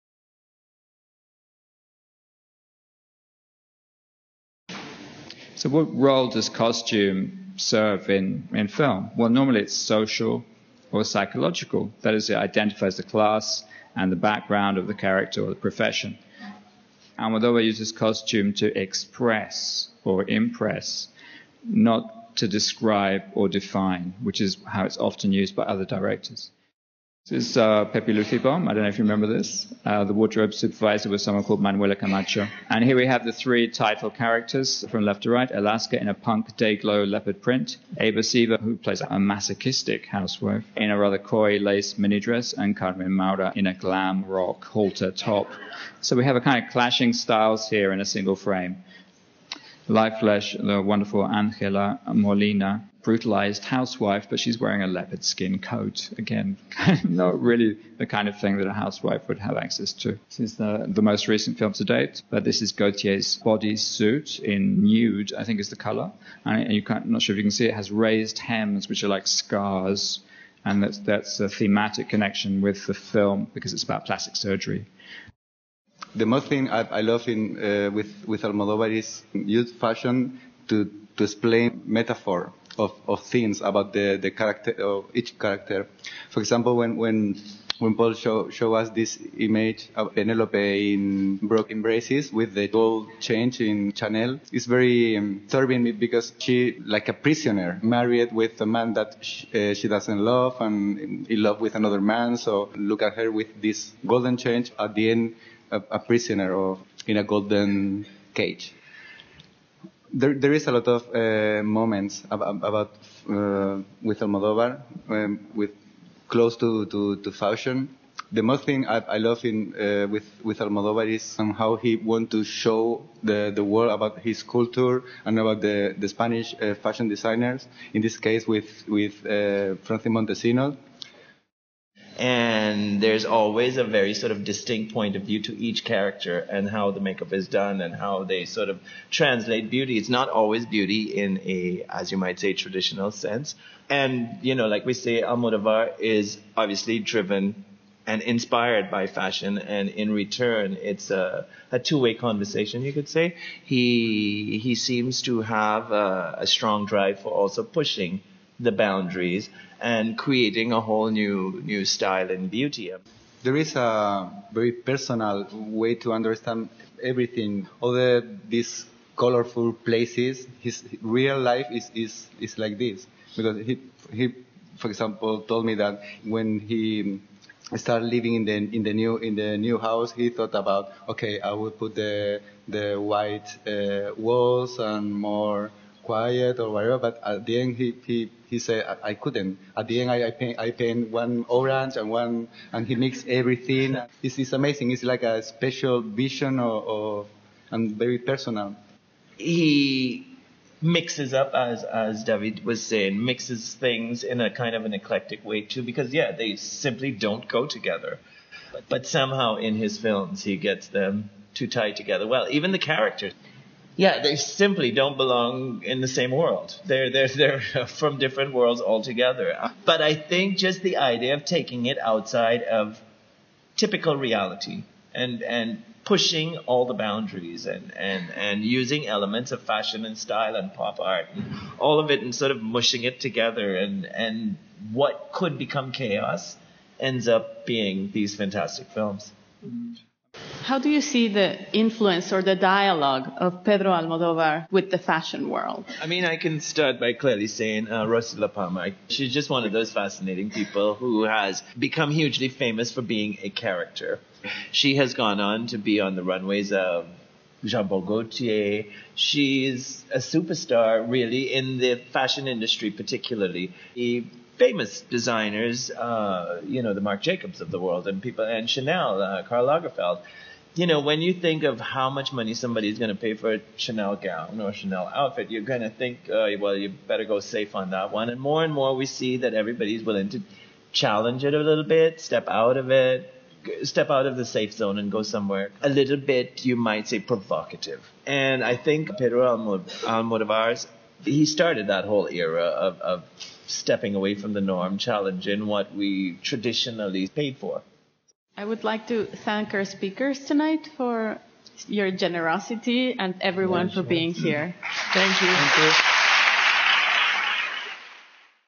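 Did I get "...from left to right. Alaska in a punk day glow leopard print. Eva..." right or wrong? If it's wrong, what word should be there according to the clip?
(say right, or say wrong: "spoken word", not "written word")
right.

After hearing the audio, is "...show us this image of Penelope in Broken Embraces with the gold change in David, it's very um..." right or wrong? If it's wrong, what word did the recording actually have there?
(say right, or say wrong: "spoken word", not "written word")
wrong: "Chanel", not "David".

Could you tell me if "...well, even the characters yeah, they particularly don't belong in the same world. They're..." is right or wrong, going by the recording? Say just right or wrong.
wrong.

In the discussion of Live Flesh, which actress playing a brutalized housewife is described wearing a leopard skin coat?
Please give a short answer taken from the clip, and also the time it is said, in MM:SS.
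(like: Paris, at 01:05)
Angela Molina, at 00:51.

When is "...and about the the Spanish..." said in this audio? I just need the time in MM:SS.
02:05.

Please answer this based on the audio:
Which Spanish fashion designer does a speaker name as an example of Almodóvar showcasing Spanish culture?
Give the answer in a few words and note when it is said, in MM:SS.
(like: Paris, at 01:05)
Francis Montesinos, at 02:09.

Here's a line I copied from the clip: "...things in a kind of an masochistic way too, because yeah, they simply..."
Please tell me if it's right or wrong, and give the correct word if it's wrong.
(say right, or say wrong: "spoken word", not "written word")
wrong: "eclectic", not "masochistic".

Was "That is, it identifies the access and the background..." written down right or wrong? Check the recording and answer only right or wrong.
wrong.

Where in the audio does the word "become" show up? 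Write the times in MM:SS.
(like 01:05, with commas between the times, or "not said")
03:55, 04:11.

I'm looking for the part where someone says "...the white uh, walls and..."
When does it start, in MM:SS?
03:02.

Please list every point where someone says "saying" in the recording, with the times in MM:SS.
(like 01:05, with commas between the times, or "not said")
03:22, 04:07.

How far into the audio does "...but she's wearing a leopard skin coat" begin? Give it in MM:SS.
00:54.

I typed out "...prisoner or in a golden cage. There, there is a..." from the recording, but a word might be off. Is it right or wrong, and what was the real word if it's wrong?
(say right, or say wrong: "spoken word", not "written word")
right.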